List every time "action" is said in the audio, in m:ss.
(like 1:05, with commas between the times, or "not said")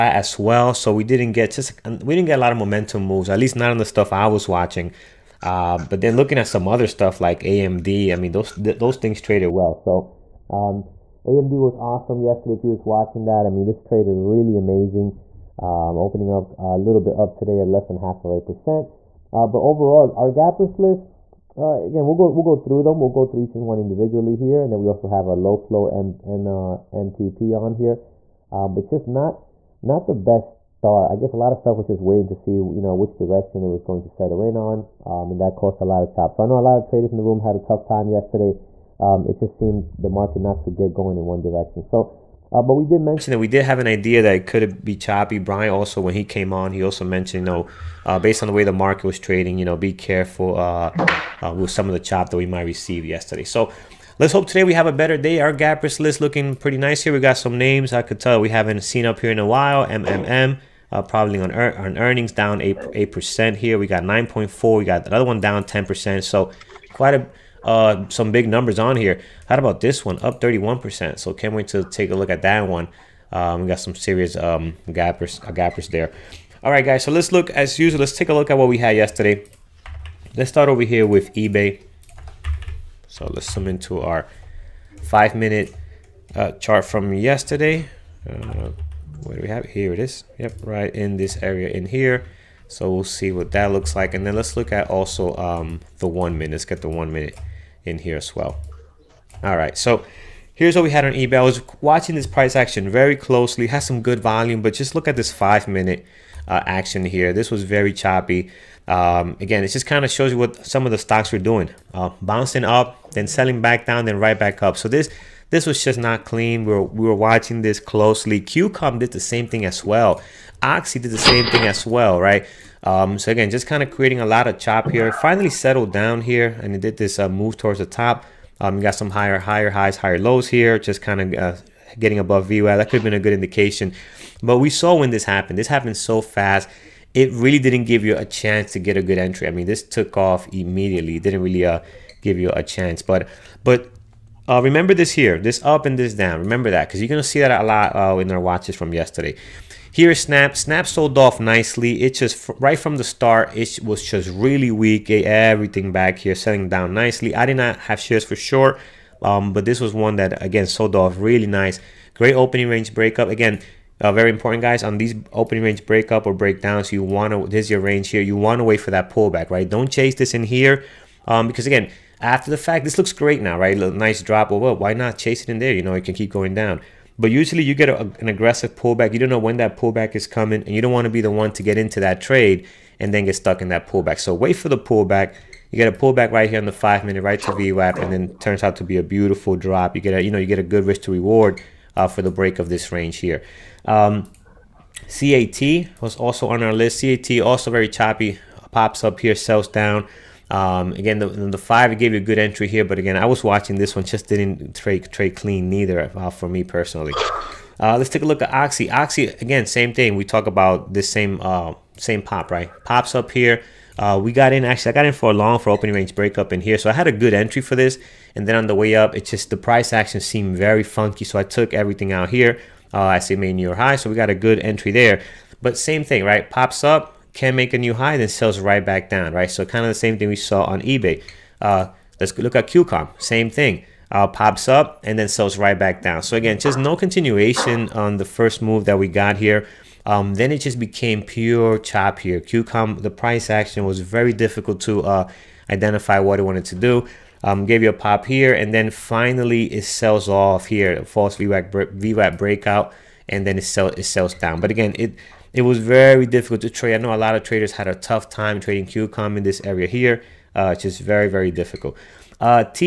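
1:42, 1:46, 3:39, 4:03.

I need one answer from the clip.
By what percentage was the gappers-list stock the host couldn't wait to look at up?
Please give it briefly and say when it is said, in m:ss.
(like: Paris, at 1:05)
31%, at 1:10.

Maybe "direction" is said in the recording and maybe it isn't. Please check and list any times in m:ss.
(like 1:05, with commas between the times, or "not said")
0:33, 0:41.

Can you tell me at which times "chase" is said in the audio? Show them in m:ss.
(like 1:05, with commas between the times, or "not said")
2:49, 2:55.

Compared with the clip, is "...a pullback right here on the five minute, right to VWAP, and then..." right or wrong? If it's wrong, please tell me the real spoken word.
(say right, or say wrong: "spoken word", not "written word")
right.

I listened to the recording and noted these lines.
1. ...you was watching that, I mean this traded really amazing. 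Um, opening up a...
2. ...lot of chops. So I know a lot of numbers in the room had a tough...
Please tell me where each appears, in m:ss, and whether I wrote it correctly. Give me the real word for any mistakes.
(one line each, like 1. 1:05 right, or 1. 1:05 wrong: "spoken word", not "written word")
1. 0:12 right
2. 0:35 wrong: "traders", not "numbers".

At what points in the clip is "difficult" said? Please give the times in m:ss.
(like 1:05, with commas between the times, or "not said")
4:04, 4:16, 4:21.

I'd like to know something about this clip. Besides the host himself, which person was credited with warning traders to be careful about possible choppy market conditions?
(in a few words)
Brian.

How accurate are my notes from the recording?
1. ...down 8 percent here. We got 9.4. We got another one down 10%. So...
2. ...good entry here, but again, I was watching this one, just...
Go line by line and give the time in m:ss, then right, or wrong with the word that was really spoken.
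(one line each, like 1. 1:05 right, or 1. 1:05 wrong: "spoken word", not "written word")
1. 1:02 right
2. 3:22 right.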